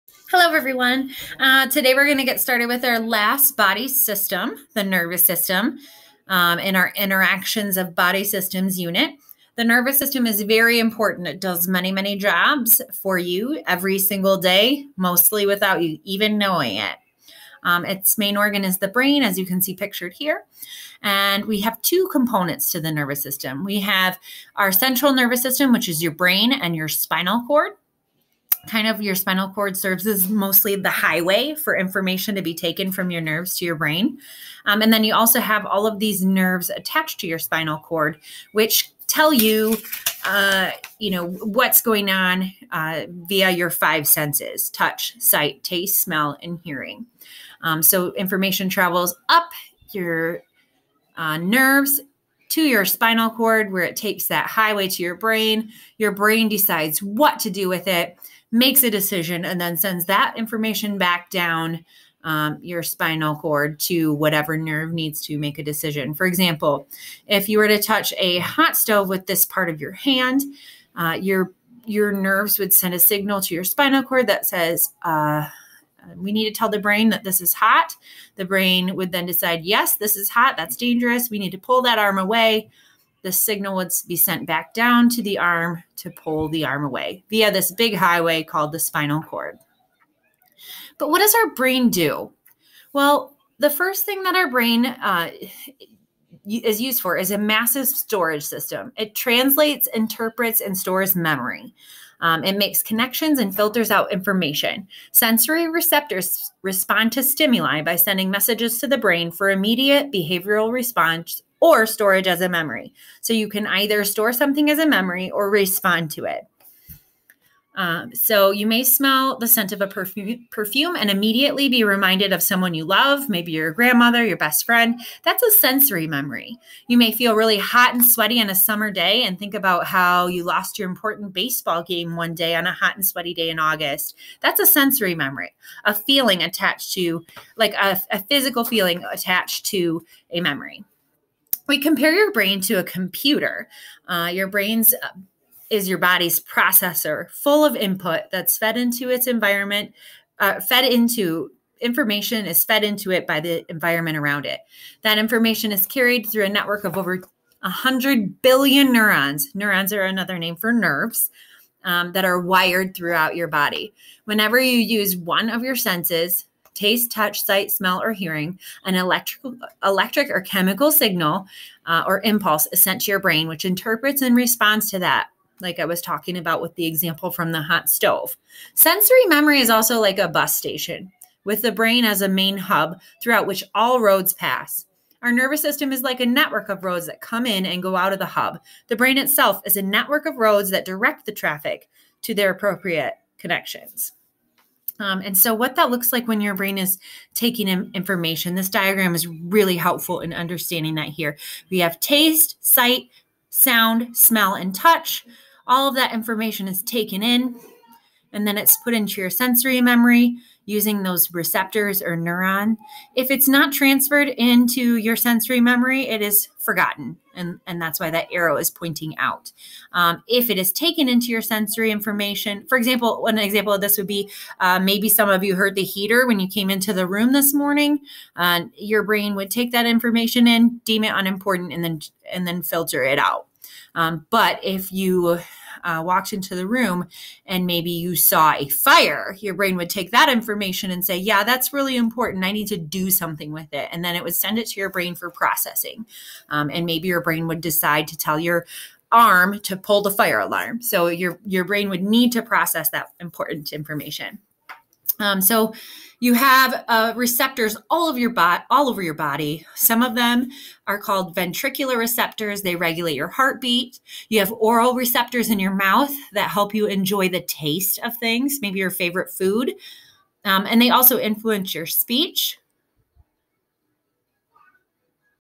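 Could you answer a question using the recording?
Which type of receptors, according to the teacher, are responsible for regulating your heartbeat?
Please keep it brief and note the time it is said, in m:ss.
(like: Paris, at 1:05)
ventricular receptors, at 4:21.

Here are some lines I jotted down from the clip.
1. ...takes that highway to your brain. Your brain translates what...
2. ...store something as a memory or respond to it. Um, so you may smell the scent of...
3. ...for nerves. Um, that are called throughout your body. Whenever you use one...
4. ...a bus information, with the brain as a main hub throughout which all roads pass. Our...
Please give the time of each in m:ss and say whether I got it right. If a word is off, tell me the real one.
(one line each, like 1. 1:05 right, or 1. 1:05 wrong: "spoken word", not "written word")
1. 0:53 wrong: "decides", not "translates"
2. 1:54 right
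3. 2:40 wrong: "wired", not "called"
4. 3:00 wrong: "station", not "information".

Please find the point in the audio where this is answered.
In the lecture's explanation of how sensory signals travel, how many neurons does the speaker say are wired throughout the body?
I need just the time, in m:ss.
2:36.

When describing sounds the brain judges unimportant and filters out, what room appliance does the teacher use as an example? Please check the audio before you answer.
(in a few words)
the heater.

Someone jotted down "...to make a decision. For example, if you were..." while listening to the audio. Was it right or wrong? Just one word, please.
right.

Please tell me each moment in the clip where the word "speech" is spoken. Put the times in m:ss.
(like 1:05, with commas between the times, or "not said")
4:31.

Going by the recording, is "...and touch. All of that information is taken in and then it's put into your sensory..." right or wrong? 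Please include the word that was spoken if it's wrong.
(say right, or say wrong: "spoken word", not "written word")
right.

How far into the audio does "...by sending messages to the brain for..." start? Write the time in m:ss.
1:47.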